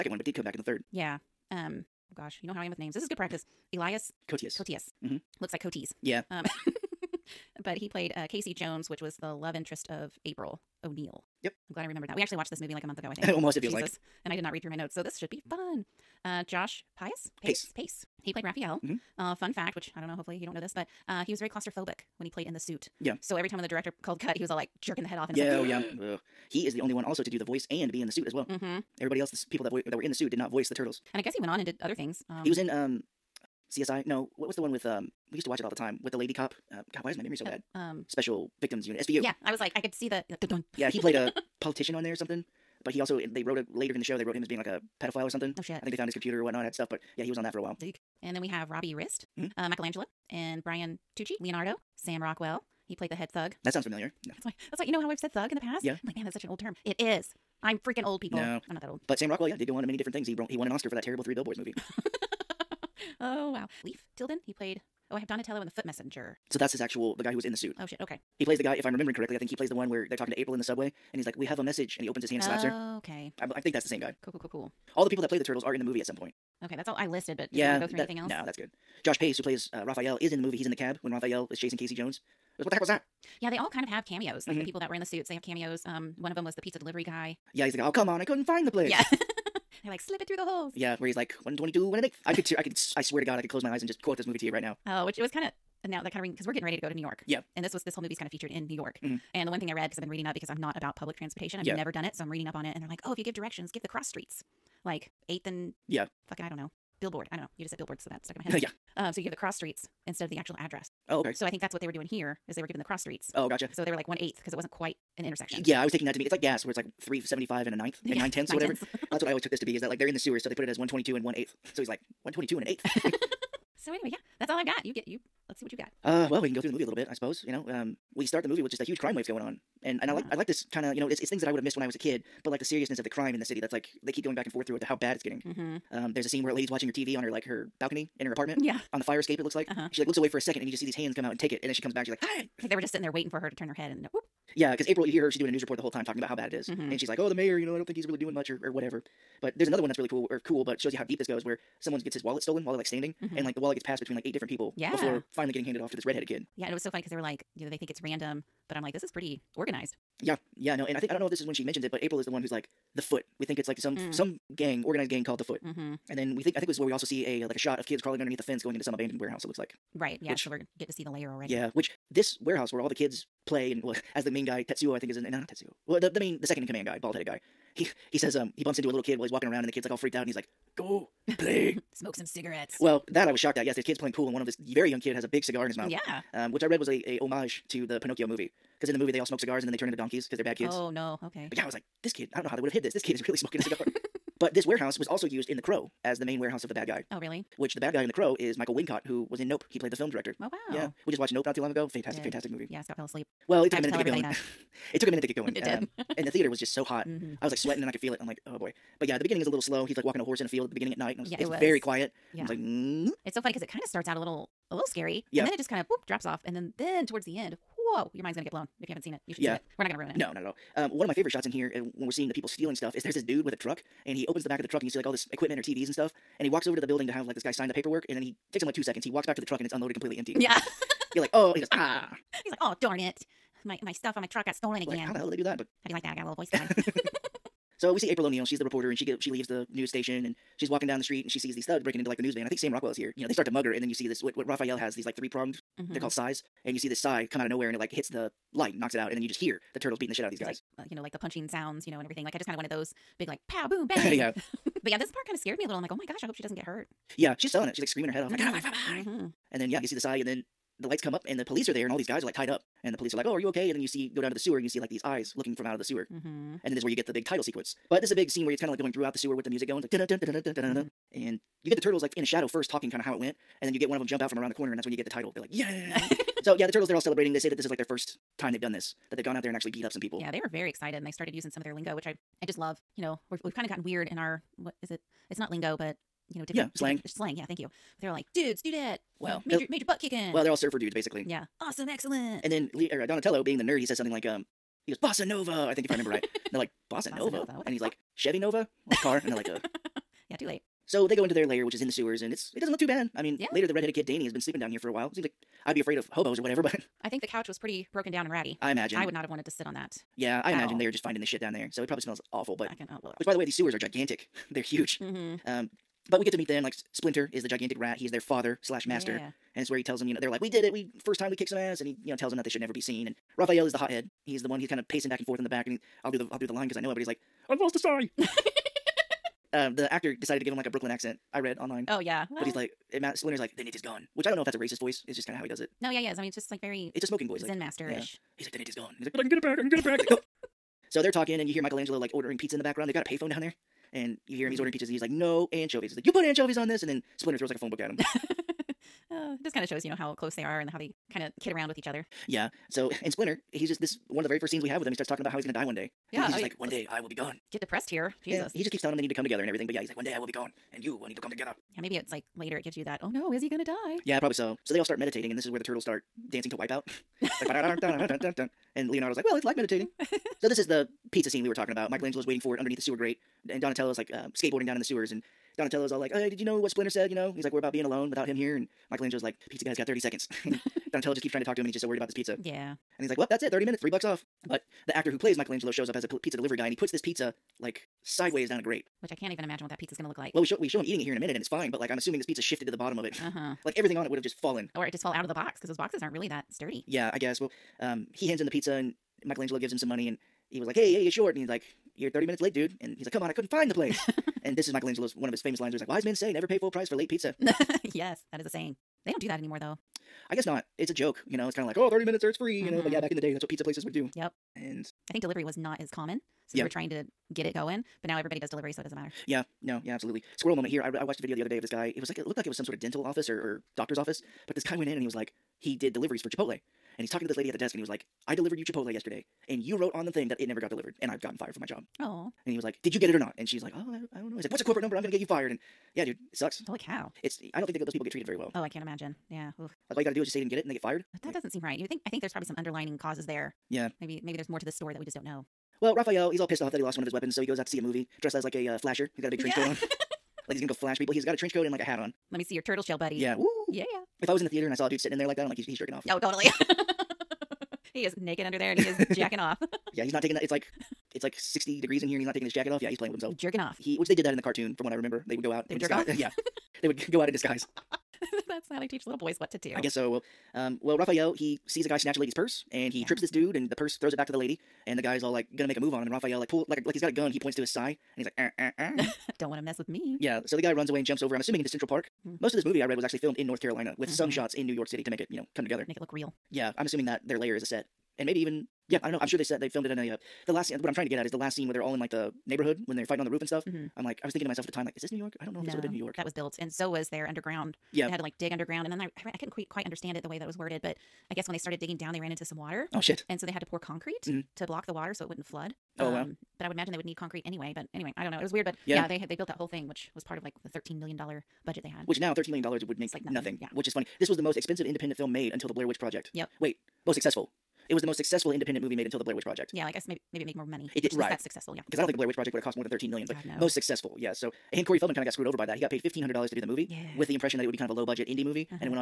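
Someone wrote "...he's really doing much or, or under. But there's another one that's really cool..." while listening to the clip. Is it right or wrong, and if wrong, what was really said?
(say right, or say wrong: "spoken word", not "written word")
wrong: "whatever", not "under".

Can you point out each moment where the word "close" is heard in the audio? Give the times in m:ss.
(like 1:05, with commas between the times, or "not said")
1:33, 5:50.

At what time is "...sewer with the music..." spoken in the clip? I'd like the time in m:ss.
4:29.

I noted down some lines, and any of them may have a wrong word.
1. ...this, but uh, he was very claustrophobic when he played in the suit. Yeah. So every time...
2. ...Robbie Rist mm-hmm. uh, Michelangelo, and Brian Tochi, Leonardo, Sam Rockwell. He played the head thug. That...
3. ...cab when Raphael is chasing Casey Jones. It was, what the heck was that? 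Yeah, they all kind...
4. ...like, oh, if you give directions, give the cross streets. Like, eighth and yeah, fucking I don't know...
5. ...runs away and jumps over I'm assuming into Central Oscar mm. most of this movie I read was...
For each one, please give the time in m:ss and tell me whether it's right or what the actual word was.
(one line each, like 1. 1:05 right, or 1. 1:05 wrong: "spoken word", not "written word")
1. 0:20 right
2. 0:48 right
3. 1:20 right
4. 1:42 right
5. 8:00 wrong: "Park", not "Oscar".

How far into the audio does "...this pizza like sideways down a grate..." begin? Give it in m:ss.
6:26.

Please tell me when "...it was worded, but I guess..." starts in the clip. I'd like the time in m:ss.
8:20.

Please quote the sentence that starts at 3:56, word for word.
I got a little voice going.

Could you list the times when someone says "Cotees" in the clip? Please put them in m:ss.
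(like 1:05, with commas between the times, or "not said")
0:05.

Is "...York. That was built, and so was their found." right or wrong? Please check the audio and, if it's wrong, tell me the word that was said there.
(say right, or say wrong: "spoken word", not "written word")
wrong: "underground", not "found".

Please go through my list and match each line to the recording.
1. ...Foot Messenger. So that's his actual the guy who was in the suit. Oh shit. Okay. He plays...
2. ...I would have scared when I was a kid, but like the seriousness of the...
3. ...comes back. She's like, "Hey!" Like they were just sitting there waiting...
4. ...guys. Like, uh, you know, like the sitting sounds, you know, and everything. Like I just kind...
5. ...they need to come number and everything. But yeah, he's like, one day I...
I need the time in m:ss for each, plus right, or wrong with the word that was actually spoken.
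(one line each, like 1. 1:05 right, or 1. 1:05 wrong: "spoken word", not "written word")
1. 1:05 right
2. 2:11 wrong: "missed", not "scared"
3. 2:21 right
4. 4:10 wrong: "punching", not "sitting"
5. 5:58 wrong: "together", not "number".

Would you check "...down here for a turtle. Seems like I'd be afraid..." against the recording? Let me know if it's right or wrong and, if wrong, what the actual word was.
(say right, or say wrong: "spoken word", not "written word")
wrong: "while", not "turtle".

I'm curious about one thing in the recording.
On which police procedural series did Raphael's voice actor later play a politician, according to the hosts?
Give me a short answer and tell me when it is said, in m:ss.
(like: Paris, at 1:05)
SVU, at 0:38.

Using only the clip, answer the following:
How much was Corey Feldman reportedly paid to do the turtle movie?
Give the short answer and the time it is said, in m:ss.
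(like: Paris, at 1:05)
$1,500, at 8:46.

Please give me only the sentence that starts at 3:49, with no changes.
He walks back to the truck, and it's unloaded, completely empty.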